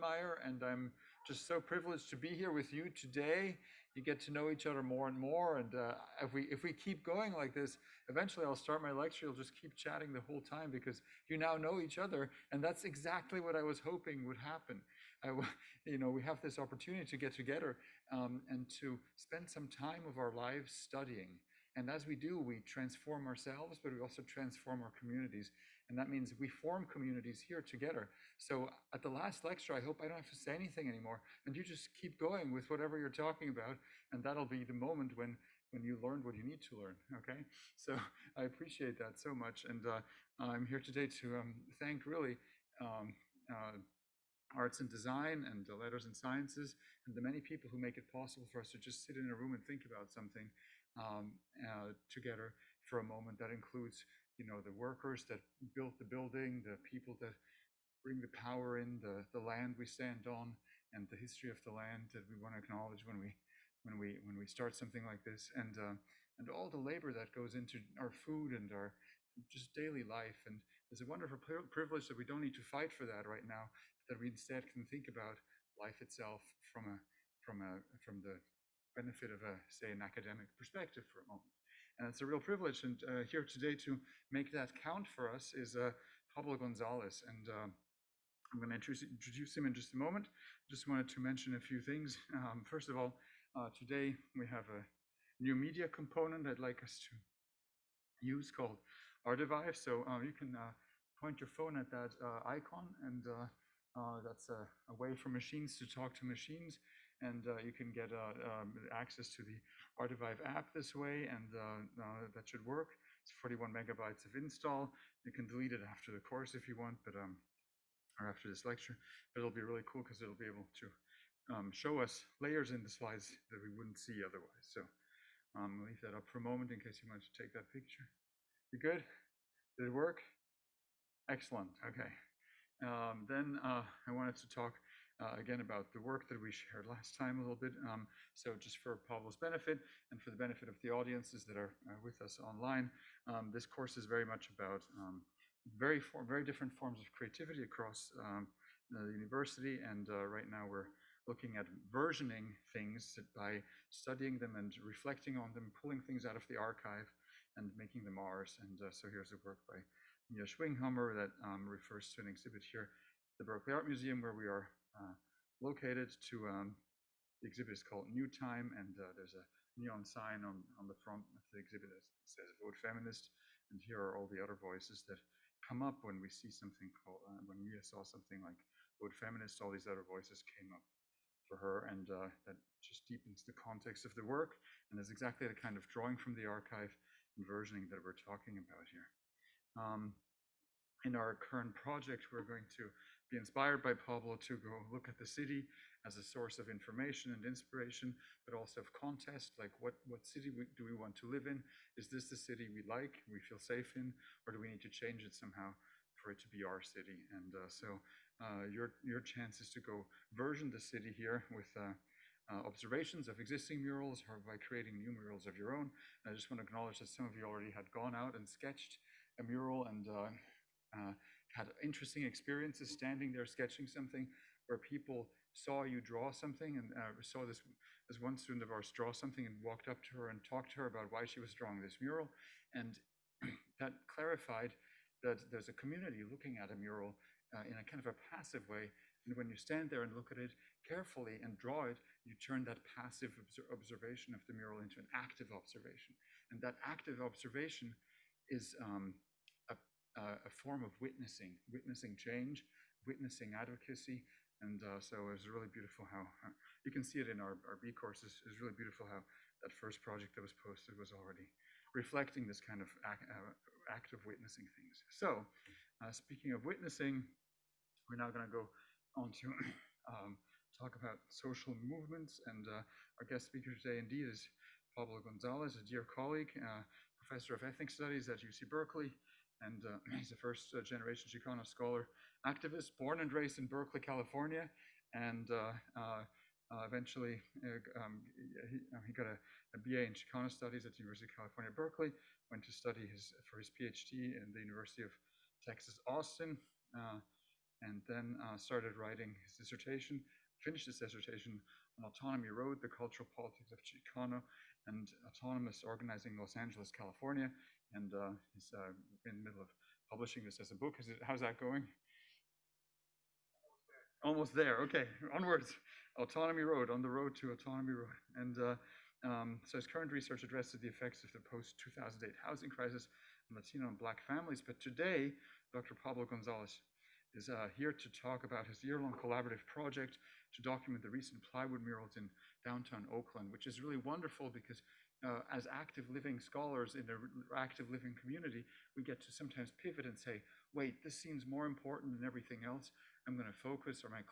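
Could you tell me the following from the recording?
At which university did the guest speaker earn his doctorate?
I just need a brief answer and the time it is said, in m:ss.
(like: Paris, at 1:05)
University of Texas, Austin, at 4:54.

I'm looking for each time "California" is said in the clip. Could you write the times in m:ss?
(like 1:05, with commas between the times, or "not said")
4:43, 4:51, 5:06.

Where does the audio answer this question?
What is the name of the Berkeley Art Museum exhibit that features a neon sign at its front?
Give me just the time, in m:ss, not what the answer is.
2:48.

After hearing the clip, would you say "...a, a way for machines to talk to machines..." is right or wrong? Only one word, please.
right.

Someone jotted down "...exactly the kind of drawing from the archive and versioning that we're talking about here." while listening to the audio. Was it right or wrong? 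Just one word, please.
right.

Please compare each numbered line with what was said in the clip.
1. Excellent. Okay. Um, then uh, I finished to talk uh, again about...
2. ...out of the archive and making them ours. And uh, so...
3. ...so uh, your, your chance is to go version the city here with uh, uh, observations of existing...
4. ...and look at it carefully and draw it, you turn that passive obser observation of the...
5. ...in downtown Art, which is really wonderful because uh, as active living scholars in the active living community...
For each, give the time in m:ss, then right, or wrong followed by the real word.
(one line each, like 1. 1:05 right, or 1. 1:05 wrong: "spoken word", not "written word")
1. 2:11 wrong: "wanted", not "finished"
2. 2:36 right
3. 3:27 right
4. 4:00 right
5. 5:32 wrong: "Oakland", not "Art".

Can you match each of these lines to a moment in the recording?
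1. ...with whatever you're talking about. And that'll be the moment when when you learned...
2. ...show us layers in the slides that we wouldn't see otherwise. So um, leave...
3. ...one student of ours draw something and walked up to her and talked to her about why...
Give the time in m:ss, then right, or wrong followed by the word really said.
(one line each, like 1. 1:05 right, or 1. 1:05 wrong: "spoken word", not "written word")
1. 0:32 right
2. 2:01 right
3. 3:48 right.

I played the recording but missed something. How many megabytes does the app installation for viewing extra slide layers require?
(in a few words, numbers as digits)
41.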